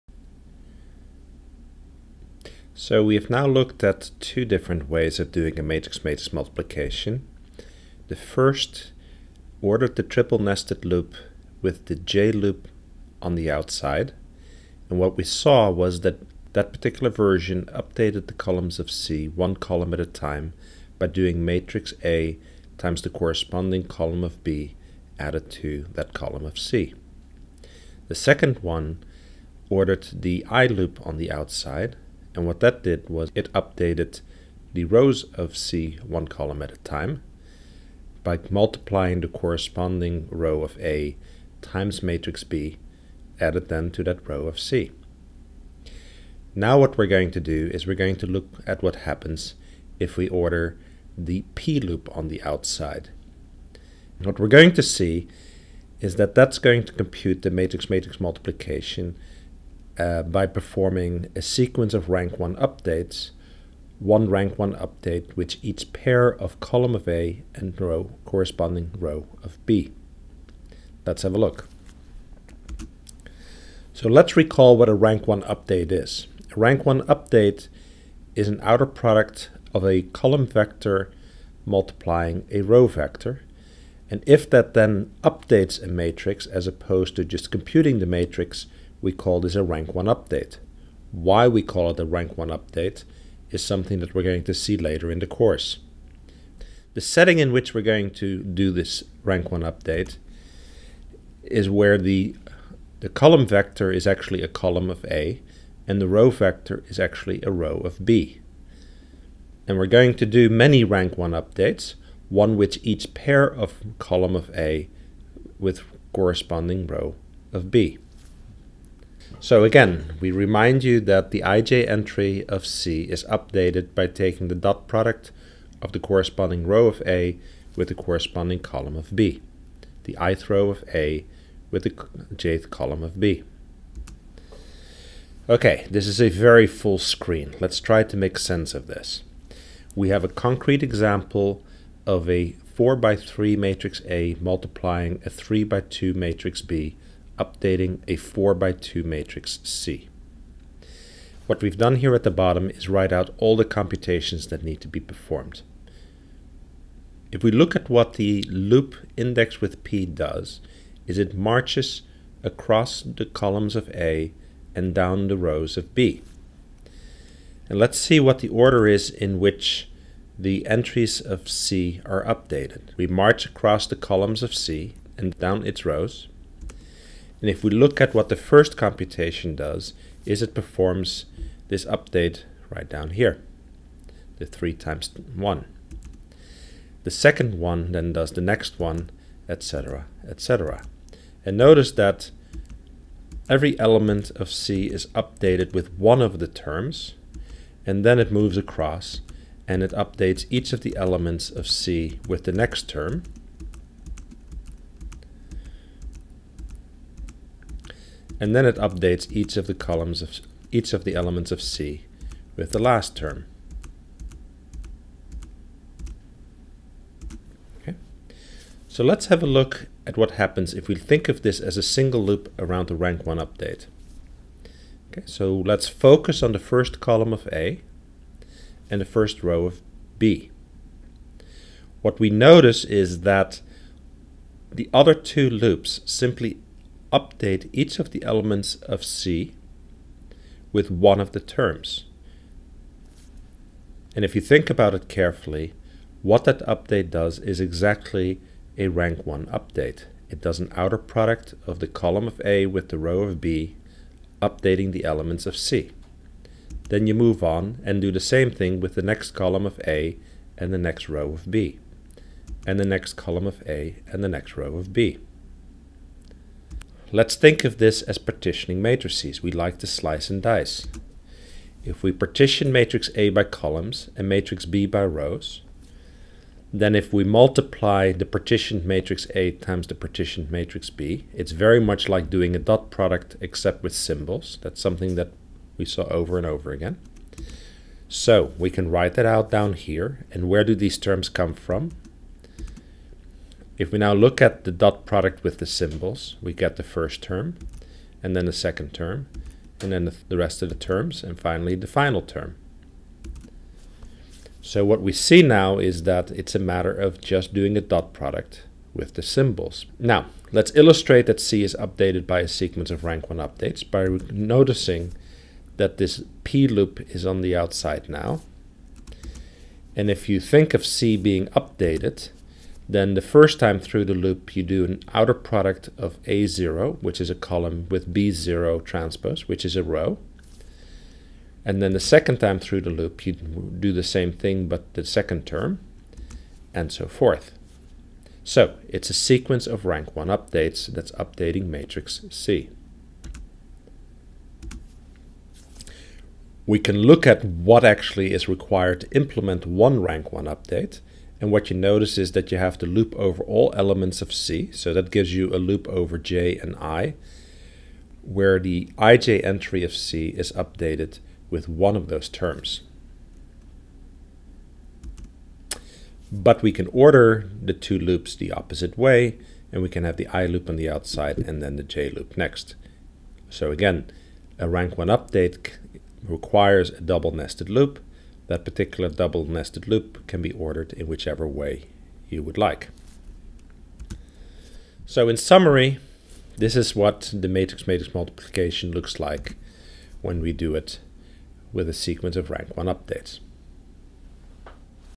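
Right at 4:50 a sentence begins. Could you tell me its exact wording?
And where do these terms come from?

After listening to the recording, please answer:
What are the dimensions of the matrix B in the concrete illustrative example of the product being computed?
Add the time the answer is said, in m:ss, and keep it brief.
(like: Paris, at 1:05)
3 by 2, at 2:25.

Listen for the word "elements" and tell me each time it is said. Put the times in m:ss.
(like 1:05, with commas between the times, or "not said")
3:13, 3:20, 3:31, 3:58, 4:15, 5:53.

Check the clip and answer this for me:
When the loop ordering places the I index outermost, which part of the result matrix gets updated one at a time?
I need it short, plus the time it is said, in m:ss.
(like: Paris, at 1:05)
rows of C, at 0:34.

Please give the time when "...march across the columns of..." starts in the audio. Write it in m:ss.
2:53.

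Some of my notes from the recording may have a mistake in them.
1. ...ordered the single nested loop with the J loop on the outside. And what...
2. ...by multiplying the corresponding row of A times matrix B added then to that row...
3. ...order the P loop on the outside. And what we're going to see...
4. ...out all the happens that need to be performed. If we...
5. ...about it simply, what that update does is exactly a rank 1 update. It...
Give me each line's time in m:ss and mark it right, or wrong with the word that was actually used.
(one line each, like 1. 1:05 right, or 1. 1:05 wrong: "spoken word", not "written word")
1. 0:09 wrong: "triple", not "single"
2. 0:38 right
3. 0:50 right
4. 2:33 wrong: "computations", not "happens"
5. 4:04 wrong: "carefully", not "simply".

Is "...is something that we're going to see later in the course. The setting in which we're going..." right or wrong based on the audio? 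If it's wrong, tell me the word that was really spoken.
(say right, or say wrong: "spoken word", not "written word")
right.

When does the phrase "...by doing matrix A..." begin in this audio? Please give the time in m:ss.
0:20.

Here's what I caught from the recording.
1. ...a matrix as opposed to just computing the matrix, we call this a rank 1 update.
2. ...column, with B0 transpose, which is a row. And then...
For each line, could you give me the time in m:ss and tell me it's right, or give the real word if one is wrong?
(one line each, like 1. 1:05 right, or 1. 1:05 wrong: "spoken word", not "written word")
1. 1:25 right
2. 5:27 right.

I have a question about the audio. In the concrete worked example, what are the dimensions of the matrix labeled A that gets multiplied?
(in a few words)
4 by 3.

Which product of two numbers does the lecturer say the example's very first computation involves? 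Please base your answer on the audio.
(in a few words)
3 times 1.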